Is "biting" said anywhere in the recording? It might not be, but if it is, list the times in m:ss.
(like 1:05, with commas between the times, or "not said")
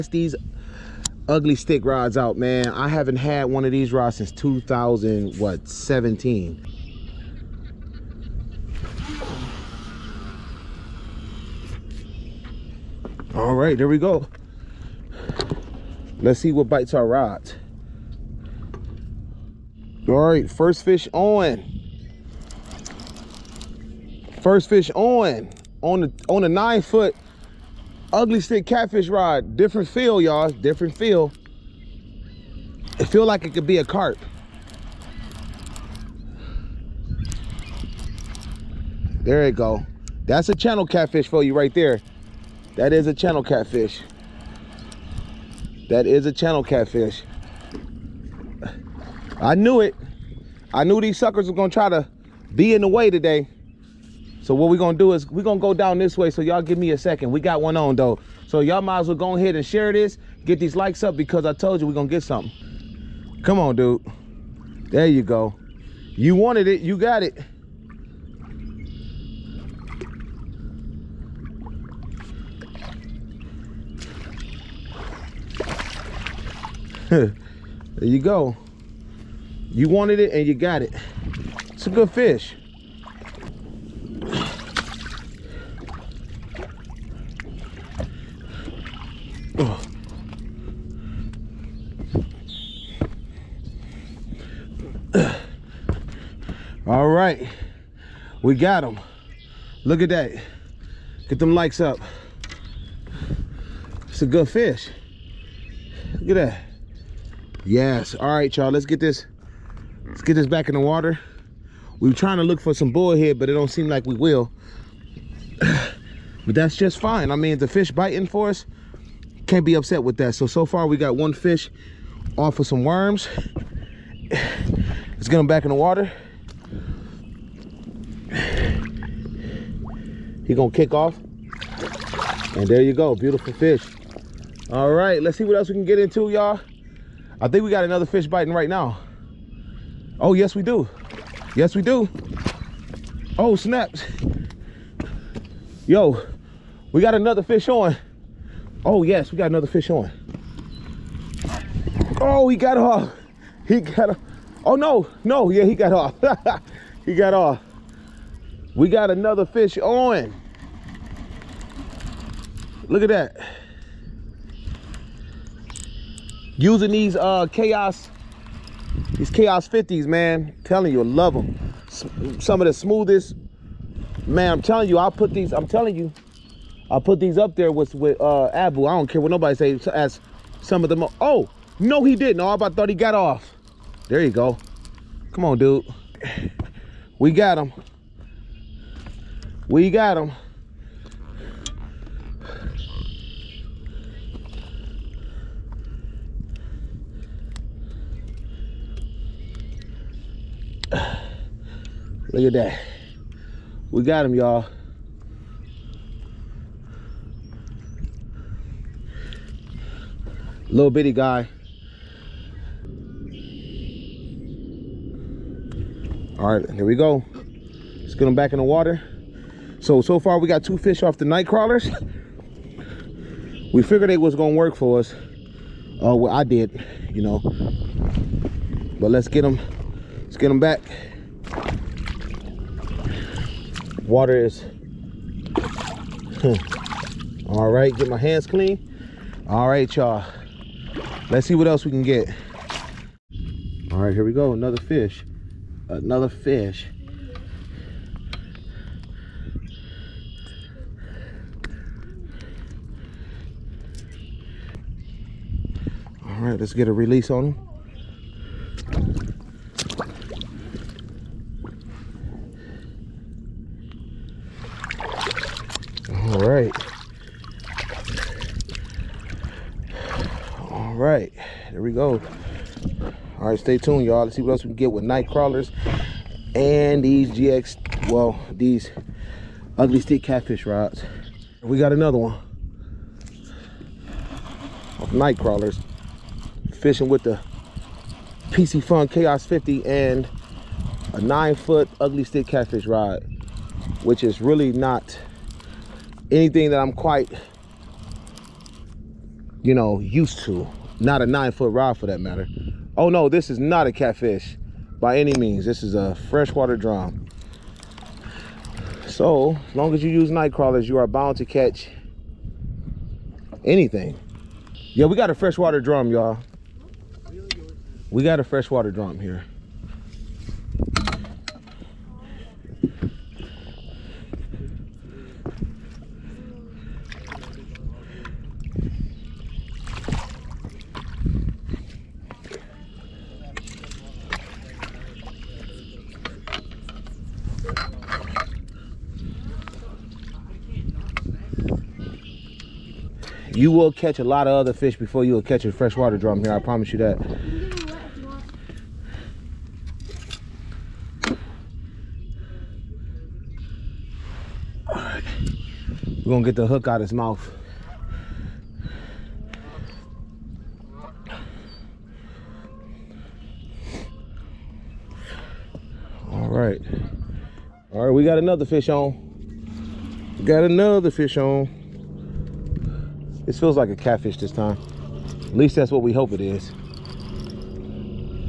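1:57, 2:18.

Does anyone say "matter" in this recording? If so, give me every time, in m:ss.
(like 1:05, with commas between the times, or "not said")
5:02.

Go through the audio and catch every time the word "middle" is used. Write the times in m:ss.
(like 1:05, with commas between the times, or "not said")
not said.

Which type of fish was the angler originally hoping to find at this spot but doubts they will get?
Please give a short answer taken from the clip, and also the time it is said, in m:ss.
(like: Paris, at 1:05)
Bullhead, at 1:52.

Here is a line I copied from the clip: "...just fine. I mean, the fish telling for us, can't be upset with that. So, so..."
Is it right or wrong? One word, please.
wrong.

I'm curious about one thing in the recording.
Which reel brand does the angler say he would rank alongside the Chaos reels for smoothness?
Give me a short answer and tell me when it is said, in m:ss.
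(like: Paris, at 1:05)
Abu, at 2:58.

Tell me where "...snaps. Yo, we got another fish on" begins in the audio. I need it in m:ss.
2:23.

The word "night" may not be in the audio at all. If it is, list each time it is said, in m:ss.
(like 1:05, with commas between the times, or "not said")
3:41, 4:35, 4:45, 5:10.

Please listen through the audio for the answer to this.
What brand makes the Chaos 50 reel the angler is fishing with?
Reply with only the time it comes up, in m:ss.
4:48.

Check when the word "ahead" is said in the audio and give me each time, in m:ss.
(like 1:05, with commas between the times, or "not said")
0:59.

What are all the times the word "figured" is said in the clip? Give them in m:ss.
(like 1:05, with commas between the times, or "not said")
3:43.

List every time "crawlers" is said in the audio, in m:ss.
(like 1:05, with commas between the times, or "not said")
3:41, 4:35, 4:45, 5:10.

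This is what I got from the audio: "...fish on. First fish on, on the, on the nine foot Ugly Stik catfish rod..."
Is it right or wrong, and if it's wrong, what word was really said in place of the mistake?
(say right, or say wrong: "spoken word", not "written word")
right.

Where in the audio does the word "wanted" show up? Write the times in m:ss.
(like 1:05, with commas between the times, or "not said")
1:06, 1:19.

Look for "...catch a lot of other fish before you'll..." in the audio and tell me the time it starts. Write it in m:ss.
5:43.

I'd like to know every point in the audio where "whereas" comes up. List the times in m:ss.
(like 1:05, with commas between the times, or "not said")
not said.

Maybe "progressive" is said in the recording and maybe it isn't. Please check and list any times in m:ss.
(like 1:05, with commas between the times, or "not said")
not said.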